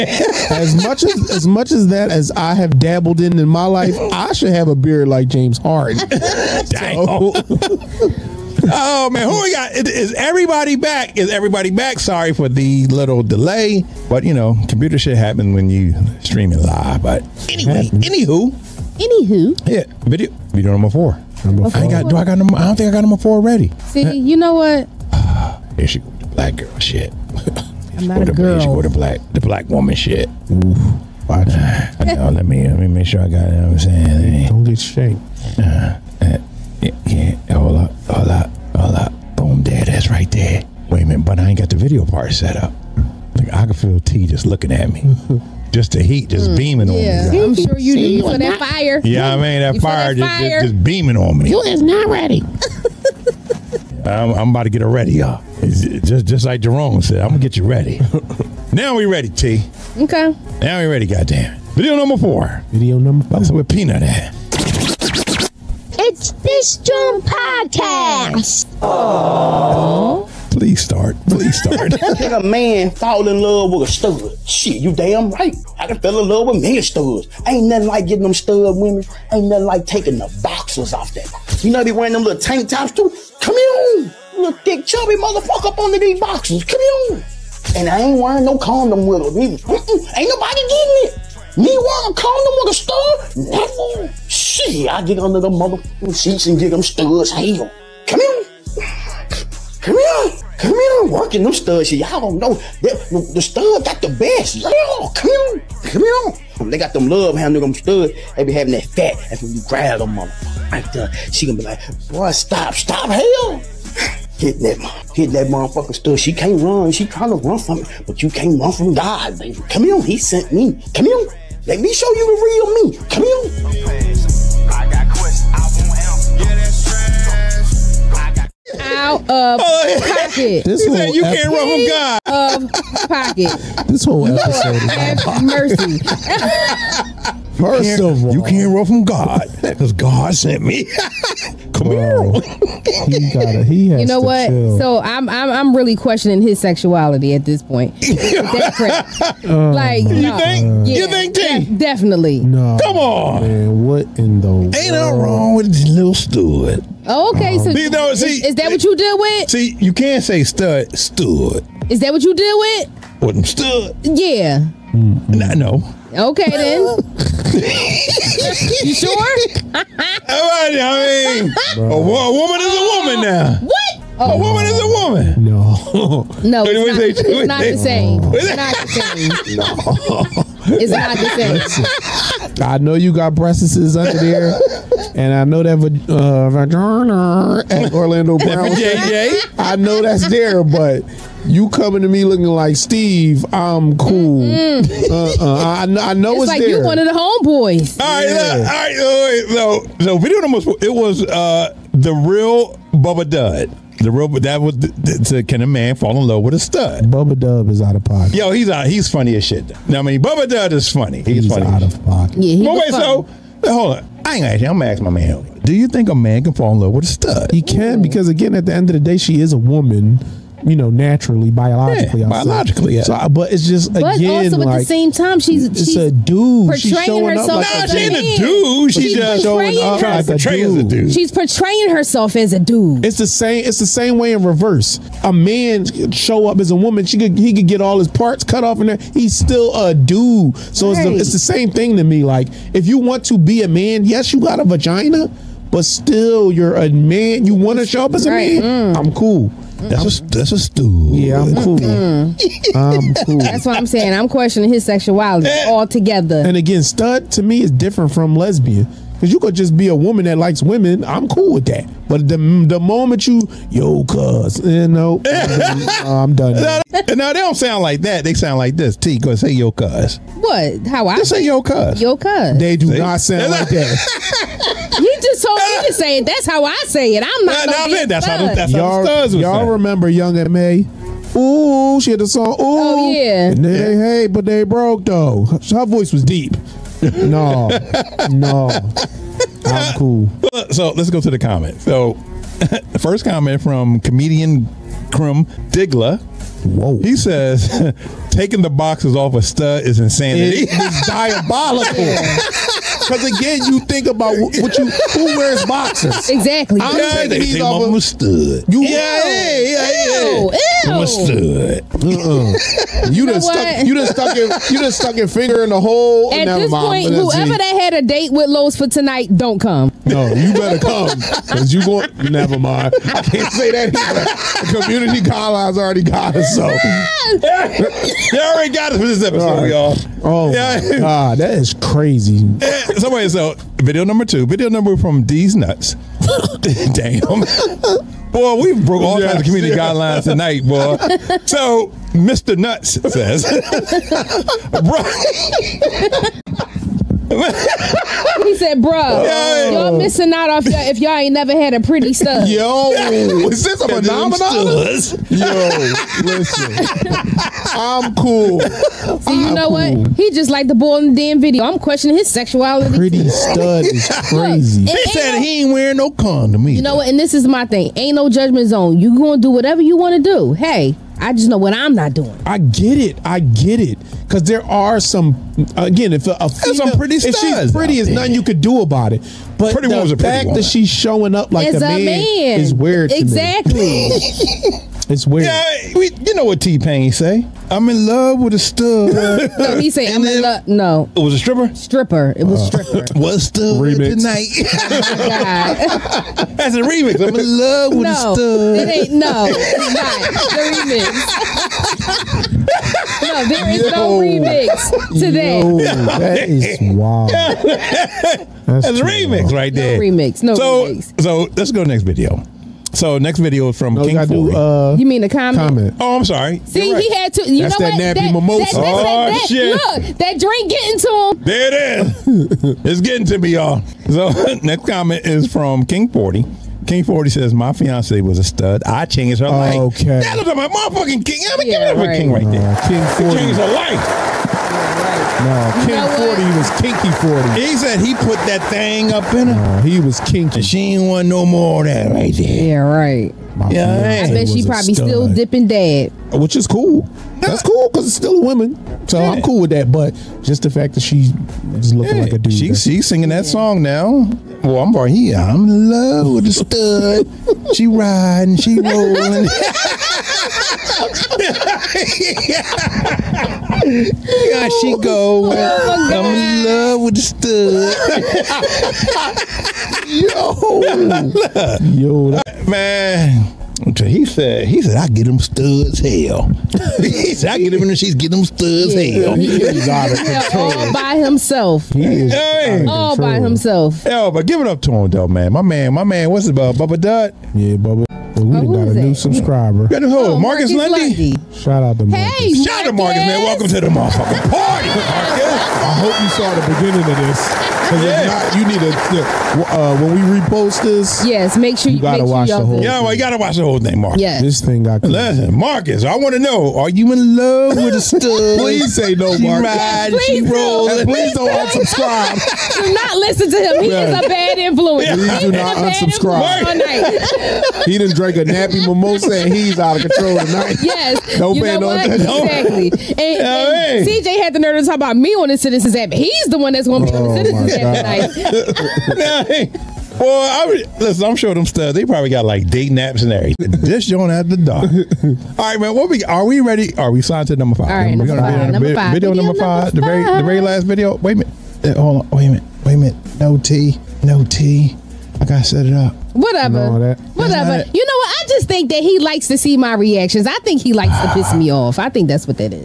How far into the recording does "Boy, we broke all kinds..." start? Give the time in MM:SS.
05:38.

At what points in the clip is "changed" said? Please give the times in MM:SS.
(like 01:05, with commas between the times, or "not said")
07:09, 07:13.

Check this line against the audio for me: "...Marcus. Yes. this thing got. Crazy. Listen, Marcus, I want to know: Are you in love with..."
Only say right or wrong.
right.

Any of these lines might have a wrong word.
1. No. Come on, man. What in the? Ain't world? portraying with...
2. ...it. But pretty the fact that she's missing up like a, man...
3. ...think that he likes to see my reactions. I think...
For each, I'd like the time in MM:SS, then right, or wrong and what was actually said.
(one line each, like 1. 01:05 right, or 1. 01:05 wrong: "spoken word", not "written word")
1. 02:32 wrong: "wrong", not "portraying"
2. 06:19 wrong: "showing", not "missing"
3. 09:08 right.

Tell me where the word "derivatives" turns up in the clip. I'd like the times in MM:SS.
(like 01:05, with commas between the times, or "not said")
not said.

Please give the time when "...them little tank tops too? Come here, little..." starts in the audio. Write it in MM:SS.
01:22.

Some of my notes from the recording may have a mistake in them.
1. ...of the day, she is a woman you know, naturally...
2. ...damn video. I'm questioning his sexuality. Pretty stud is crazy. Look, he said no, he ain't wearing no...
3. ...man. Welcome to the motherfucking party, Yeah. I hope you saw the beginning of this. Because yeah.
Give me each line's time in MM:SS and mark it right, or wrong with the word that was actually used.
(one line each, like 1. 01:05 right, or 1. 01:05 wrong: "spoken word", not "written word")
1. 03:38 right
2. 06:01 right
3. 08:13 wrong: "Marcus", not "Yeah".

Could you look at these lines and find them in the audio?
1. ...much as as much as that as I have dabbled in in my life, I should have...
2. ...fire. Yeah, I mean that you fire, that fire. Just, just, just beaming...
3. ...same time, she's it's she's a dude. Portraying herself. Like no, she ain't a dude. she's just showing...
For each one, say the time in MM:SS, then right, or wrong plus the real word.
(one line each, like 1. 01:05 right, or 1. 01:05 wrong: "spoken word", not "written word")
1. 00:00 right
2. 00:48 right
3. 03:44 right.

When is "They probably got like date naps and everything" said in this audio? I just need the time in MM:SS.
08:51.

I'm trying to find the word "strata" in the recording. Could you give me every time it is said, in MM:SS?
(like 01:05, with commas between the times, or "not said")
not said.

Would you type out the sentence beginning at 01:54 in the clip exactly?
Hit that, hit that motherfucker stud.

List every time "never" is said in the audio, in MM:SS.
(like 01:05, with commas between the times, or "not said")
01:33, 05:22, 05:51.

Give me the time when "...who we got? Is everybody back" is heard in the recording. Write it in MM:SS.
00:09.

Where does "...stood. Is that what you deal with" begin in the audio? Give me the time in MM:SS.
02:40.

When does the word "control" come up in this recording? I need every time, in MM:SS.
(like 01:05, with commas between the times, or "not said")
08:00, 08:40.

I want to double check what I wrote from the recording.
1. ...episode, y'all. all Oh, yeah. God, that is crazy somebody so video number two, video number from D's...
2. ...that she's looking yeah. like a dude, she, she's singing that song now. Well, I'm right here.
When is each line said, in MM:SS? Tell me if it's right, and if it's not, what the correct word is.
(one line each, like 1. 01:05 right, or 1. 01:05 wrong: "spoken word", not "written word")
1. 05:29 right
2. 07:30 right.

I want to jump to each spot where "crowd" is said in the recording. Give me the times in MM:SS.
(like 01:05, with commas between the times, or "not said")
not said.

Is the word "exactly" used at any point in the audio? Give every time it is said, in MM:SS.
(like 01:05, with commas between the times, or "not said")
05:06, 06:23, 08:41.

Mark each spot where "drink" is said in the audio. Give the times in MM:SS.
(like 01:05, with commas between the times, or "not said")
07:00, 08:38.